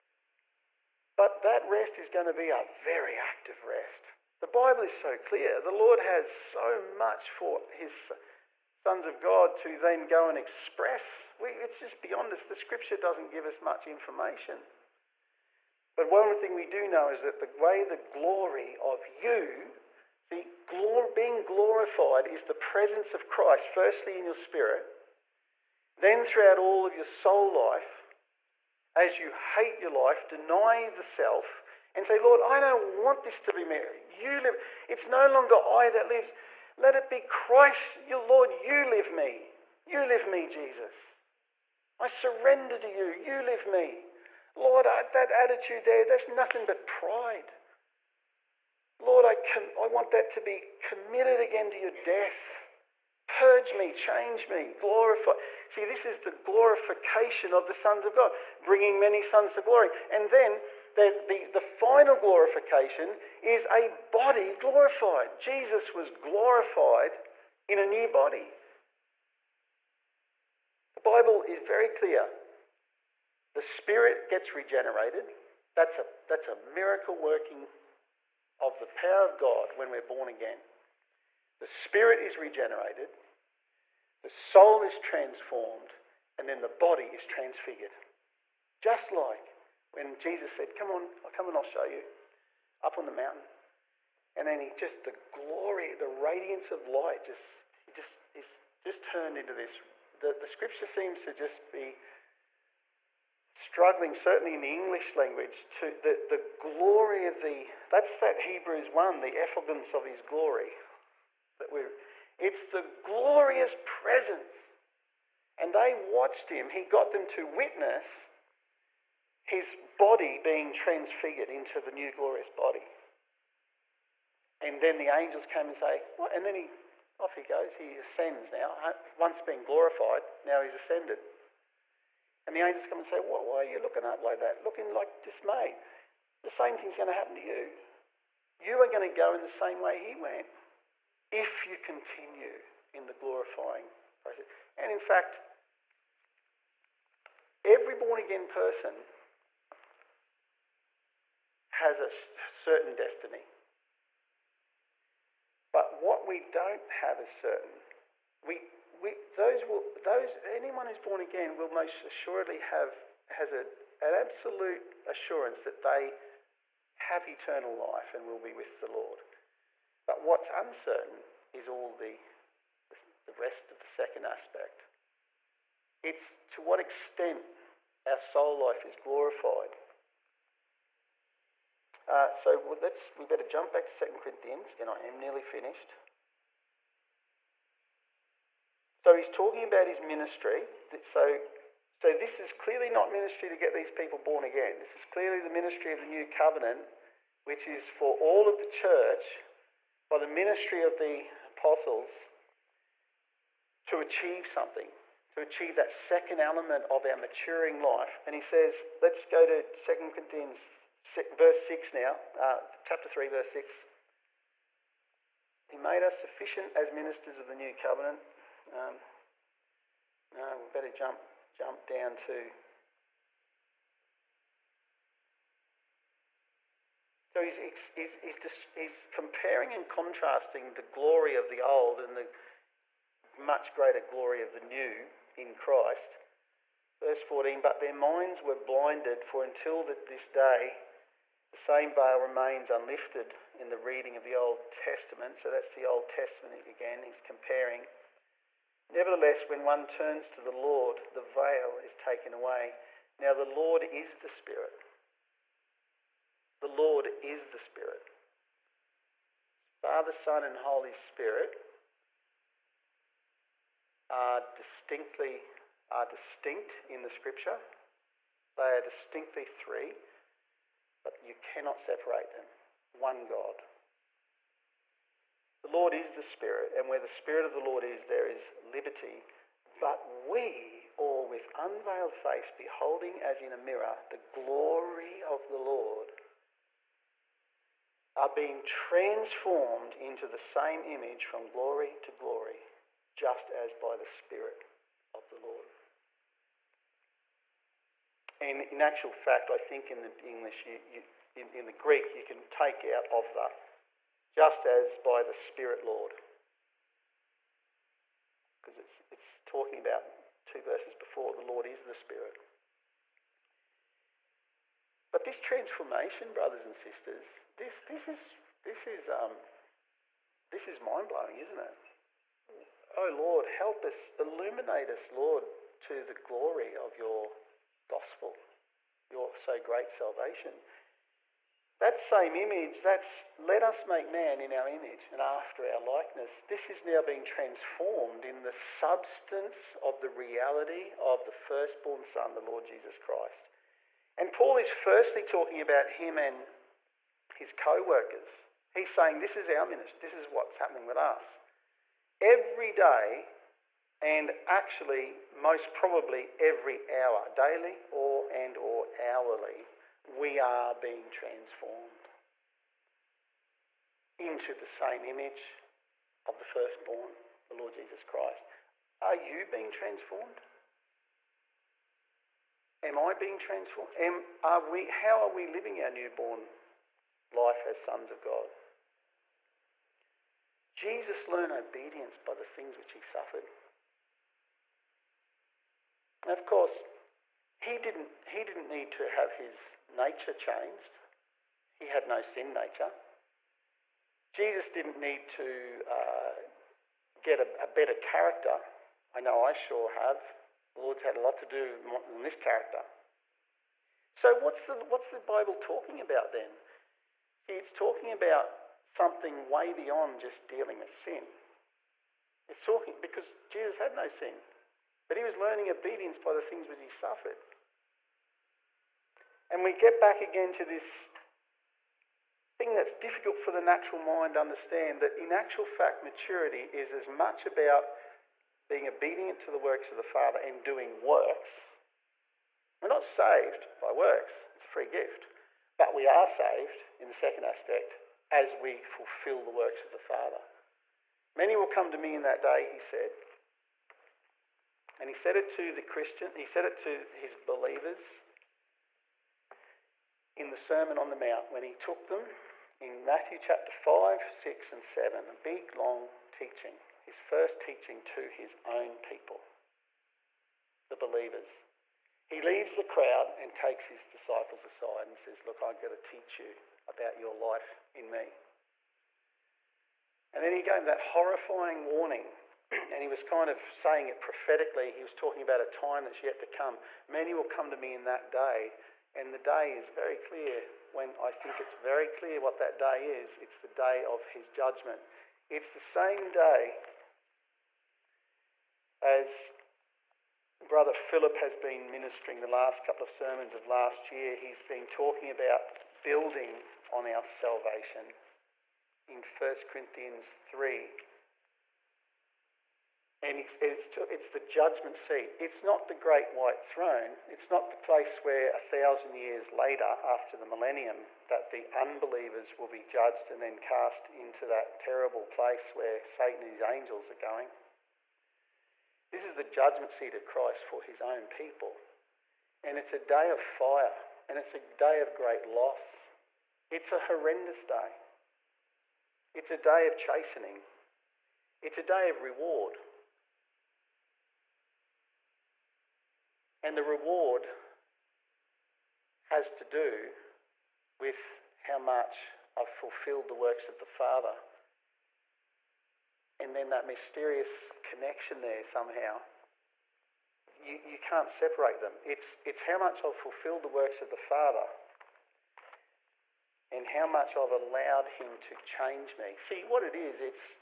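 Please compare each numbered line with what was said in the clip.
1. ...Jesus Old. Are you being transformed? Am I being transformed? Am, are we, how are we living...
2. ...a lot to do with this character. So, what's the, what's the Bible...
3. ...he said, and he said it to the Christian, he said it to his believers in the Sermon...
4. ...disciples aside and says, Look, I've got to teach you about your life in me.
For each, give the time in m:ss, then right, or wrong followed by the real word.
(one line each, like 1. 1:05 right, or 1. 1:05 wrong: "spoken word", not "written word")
1. 6:07 wrong: "Christ", not "Old"
2. 6:41 right
3. 7:22 right
4. 7:44 right.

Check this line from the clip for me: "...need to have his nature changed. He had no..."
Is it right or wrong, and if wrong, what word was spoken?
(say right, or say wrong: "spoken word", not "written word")
right.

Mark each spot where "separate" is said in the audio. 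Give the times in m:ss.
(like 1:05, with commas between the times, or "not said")
4:31, 9:11.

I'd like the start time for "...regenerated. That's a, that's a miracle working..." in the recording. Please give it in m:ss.
1:14.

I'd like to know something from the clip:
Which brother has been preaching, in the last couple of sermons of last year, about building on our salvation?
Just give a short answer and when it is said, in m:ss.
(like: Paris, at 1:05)
Brother Philip, at 8:10.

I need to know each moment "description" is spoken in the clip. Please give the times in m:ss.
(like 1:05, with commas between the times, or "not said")
not said.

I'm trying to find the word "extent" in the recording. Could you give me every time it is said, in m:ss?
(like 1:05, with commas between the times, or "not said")
2:56.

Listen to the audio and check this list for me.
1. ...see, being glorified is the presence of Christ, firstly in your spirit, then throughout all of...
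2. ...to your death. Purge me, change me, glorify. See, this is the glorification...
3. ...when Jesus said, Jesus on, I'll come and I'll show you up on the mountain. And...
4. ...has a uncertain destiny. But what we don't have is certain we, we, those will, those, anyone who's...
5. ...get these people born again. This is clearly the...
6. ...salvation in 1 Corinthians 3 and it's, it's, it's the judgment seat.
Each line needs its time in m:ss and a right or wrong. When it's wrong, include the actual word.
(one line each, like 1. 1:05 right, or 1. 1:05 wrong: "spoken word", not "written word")
1. 0:20 right
2. 0:51 right
3. 1:29 wrong: "Come", not "Jesus"
4. 2:31 wrong: "certain", not "uncertain"
5. 3:13 right
6. 8:17 right.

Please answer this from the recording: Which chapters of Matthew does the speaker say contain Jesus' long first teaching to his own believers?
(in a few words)
5, 6, and 7.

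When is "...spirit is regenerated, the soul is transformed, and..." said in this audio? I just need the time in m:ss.
1:21.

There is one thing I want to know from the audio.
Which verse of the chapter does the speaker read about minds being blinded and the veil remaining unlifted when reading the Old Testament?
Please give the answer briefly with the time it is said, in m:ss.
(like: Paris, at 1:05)
Verse 14, at 3:56.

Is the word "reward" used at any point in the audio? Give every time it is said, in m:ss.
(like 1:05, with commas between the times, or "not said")
8:52, 8:56.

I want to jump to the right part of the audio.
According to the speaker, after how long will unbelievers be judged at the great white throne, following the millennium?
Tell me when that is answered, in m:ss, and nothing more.
8:28.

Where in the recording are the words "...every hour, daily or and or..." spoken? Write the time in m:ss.
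5:56.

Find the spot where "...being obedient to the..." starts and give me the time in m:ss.
7:08.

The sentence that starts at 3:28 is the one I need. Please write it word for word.
And he says, let's go to 2 Corinthians verse 6 now, uh, chapter 3, verse 6.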